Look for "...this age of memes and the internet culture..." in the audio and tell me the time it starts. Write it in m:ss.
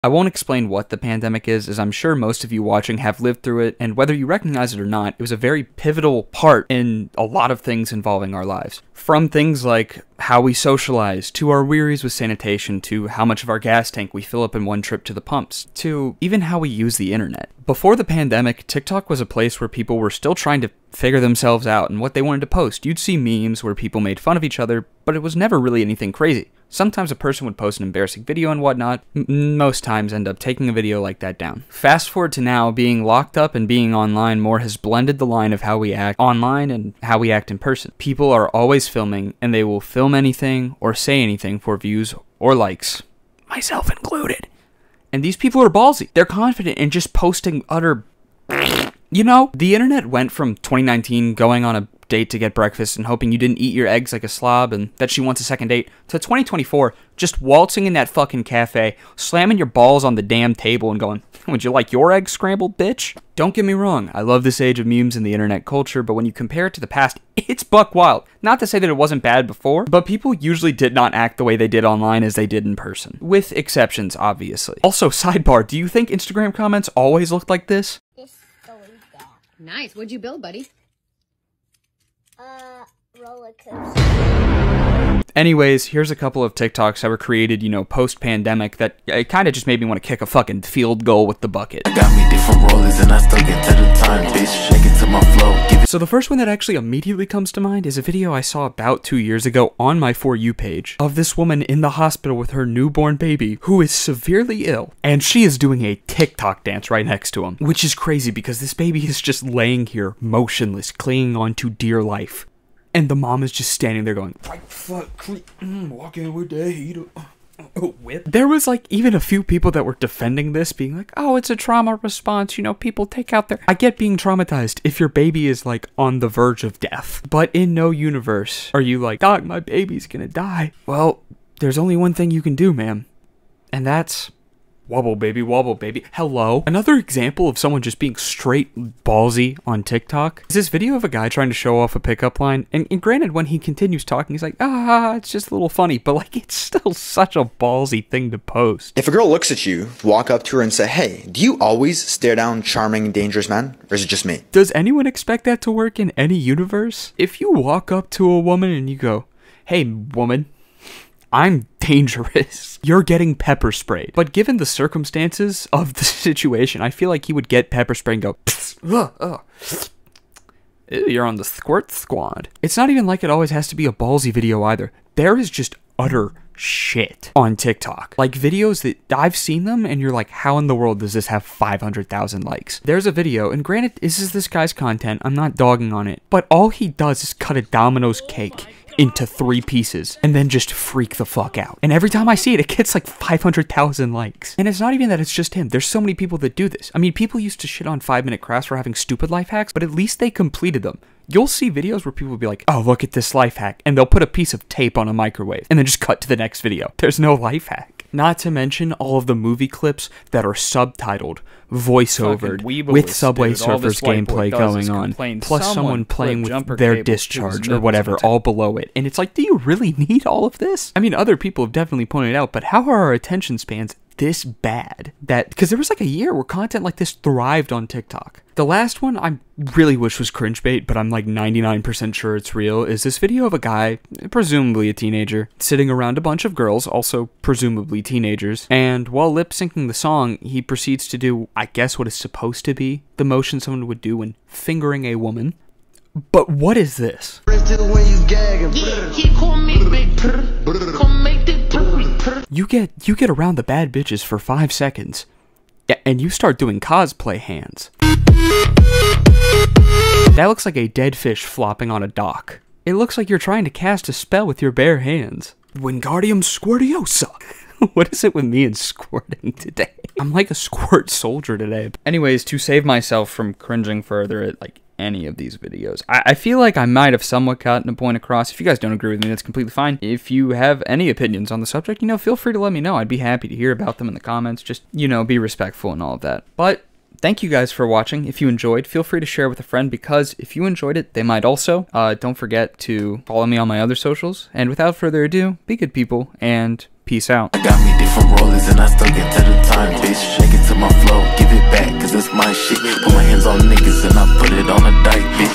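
1:04.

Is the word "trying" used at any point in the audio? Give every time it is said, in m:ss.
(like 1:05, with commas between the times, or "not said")
0:20, 2:21, 4:23.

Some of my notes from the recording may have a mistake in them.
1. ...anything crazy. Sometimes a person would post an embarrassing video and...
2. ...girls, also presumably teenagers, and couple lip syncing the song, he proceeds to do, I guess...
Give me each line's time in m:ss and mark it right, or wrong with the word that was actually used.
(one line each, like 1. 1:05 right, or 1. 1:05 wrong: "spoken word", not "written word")
1. 0:25 right
2. 3:56 wrong: "while", not "couple".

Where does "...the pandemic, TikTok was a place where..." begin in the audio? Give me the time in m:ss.
0:17.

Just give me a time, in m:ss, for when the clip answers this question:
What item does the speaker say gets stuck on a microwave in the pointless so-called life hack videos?
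3:24.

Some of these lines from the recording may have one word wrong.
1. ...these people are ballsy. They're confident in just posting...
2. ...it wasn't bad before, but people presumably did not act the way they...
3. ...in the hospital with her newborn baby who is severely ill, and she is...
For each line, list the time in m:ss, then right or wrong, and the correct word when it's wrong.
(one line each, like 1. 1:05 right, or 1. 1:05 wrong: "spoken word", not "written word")
1. 0:45 right
2. 1:08 wrong: "usually", not "presumably"
3. 1:41 right.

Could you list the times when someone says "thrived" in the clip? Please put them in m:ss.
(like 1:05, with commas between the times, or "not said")
3:47.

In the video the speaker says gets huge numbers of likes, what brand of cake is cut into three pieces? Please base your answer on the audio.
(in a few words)
Domino's.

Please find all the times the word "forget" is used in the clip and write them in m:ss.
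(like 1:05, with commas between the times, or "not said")
4:52.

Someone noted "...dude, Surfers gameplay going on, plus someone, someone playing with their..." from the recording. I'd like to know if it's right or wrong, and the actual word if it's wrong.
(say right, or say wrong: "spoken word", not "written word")
right.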